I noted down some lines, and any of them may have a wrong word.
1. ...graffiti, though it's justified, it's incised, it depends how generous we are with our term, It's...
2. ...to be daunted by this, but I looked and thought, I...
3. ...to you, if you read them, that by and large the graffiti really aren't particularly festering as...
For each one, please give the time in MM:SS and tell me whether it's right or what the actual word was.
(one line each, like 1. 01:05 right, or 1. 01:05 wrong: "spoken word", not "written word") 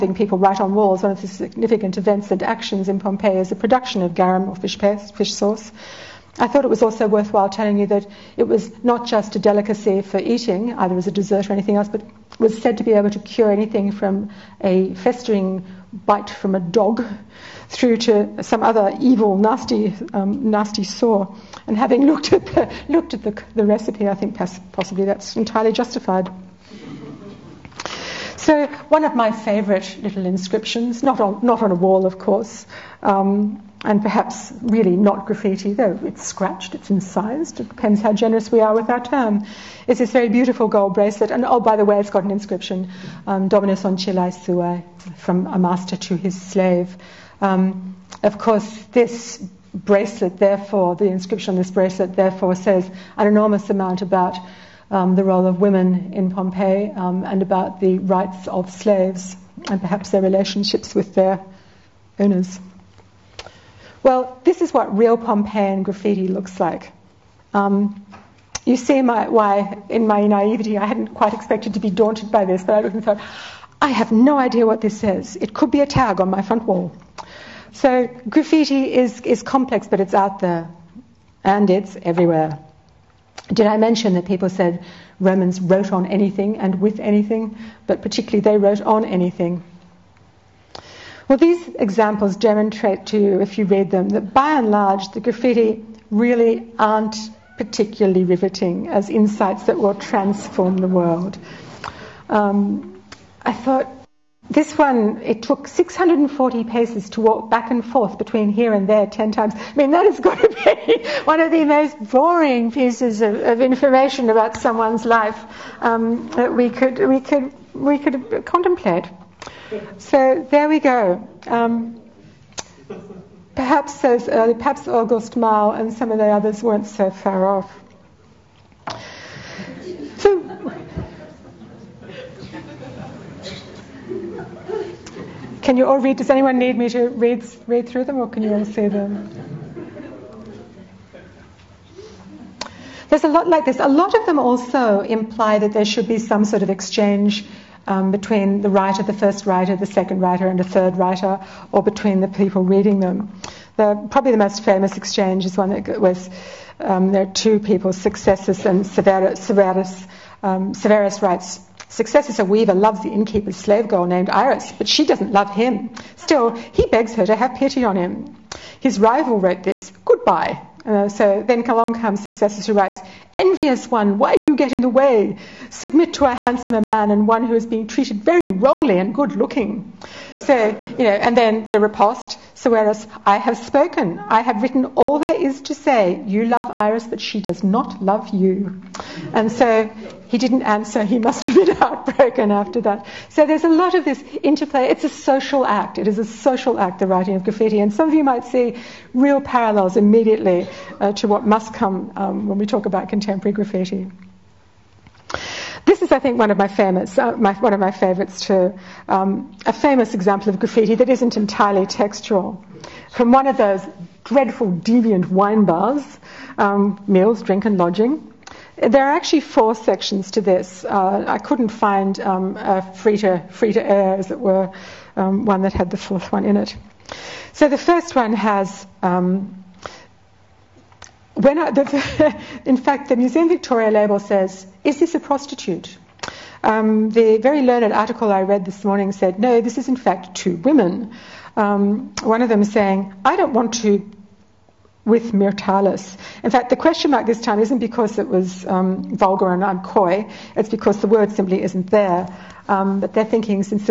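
1. 00:35 wrong: "scratched", not "justified"
2. 01:11 right
3. 01:33 wrong: "riveting", not "festering".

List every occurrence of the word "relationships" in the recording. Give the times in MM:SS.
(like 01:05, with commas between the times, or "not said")
01:00.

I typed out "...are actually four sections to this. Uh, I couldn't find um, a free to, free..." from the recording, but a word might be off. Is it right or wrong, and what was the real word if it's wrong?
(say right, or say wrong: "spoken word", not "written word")
right.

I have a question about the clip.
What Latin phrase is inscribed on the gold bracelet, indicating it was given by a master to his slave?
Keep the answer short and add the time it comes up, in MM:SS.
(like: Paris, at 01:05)
Dominus Ancillai Suae, at 00:43.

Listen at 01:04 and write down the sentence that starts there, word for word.
Well, this is what real Pompeian graffiti looks like.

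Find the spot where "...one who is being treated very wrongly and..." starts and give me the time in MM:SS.
02:57.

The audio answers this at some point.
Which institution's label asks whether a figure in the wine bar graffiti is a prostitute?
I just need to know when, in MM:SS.
03:53.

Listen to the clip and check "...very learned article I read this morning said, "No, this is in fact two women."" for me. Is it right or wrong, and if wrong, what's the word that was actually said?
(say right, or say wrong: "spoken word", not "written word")
right.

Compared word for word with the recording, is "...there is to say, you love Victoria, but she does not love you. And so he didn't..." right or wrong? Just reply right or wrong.
wrong.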